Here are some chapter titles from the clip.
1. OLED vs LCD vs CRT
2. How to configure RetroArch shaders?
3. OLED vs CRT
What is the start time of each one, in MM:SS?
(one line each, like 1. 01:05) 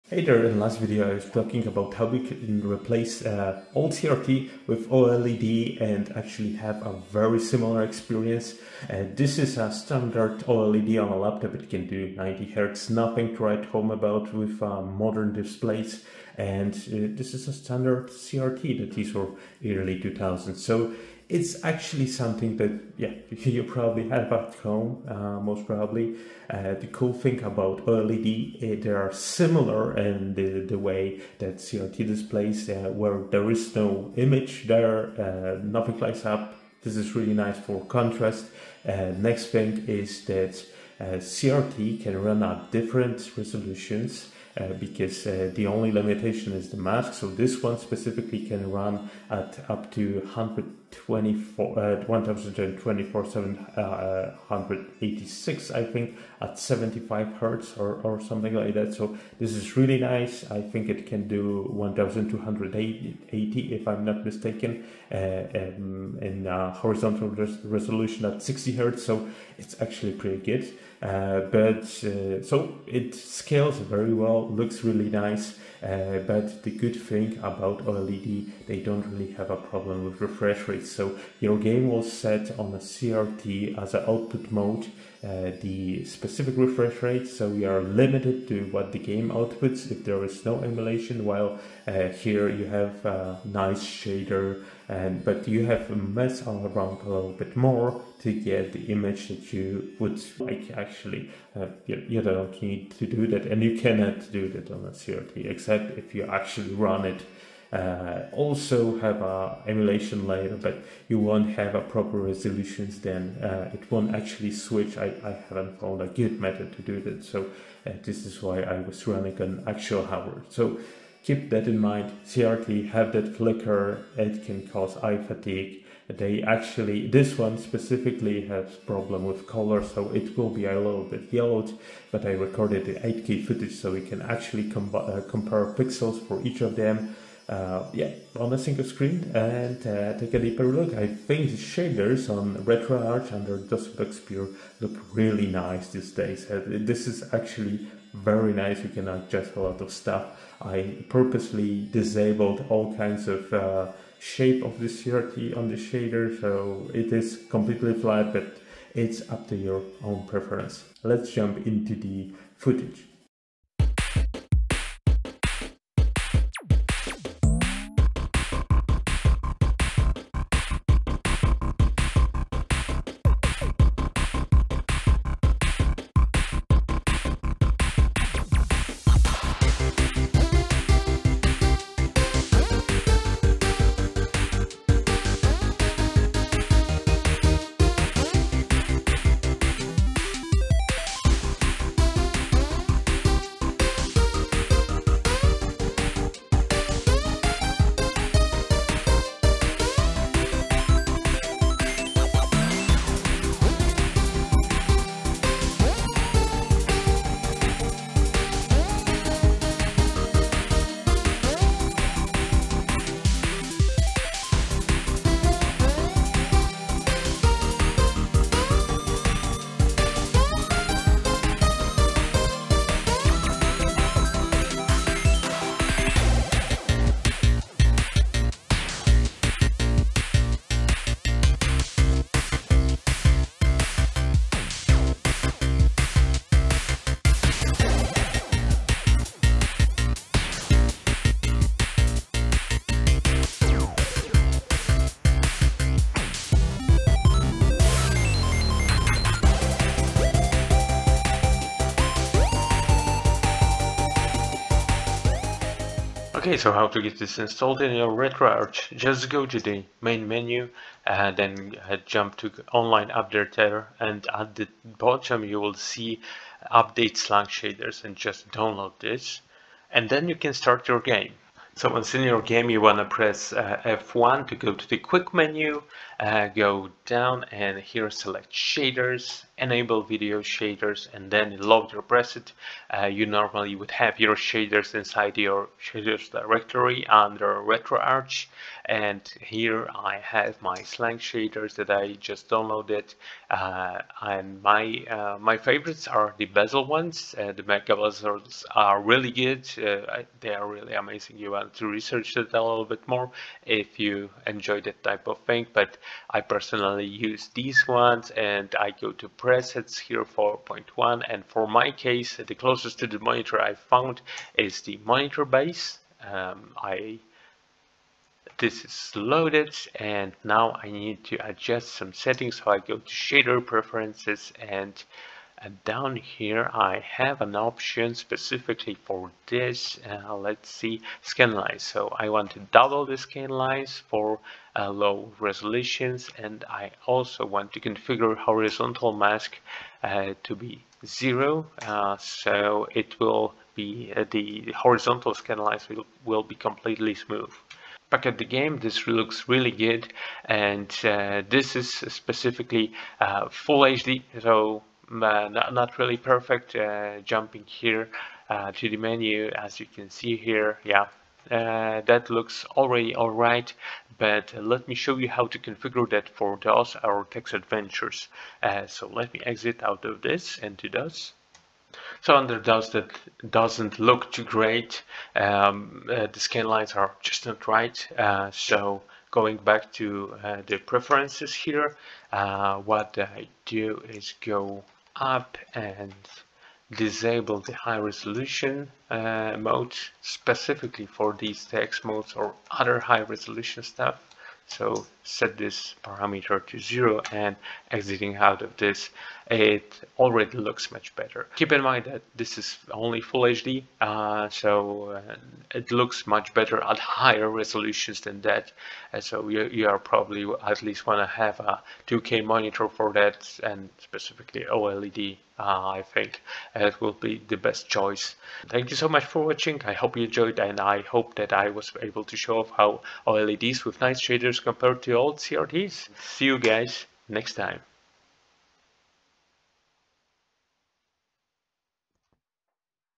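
1. 03:41
2. 04:16
3. 02:43.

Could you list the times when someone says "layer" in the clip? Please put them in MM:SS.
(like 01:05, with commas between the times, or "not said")
01:50.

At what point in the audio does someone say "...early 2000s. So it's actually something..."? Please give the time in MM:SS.
00:19.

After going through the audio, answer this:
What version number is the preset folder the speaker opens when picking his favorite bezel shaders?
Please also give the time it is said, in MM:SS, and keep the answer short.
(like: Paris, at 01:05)
4.1, at 05:10.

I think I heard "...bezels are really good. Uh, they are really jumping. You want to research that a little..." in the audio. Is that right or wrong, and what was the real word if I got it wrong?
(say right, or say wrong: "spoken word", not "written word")
wrong: "amazing", not "jumping".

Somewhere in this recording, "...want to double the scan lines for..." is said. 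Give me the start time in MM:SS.
05:32.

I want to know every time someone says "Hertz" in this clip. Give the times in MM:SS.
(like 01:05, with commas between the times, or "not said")
00:57, 01:08.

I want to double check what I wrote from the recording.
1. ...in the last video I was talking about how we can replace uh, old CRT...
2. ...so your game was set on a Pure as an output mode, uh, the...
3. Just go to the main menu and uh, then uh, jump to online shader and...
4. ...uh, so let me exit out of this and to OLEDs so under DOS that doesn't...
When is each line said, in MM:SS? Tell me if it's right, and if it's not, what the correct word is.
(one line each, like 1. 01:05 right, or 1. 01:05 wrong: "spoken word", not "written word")
1. 00:00 right
2. 01:20 wrong: "CRT", not "Pure"
3. 04:18 wrong: "updater", not "shader"
4. 06:08 wrong: "DOS", not "OLEDs".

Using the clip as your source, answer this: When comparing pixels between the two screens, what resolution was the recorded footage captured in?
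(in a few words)
8K.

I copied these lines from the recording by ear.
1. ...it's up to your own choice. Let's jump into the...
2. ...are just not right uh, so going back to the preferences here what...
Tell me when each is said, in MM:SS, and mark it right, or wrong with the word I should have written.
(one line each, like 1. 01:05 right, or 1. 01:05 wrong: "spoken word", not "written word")
1. 02:38 wrong: "preference", not "choice"
2. 06:16 right.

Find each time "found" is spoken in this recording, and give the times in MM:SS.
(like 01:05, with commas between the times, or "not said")
01:55, 05:13.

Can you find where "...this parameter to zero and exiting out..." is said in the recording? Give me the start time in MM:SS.
06:35.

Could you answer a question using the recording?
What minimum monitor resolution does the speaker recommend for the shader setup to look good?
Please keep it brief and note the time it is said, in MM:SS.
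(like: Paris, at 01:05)
2K, at 06:52.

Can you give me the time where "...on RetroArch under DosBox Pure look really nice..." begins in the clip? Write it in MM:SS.
02:22.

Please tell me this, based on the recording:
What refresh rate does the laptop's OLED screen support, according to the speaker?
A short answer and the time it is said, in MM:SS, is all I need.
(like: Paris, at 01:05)
90 Hz, at 00:12.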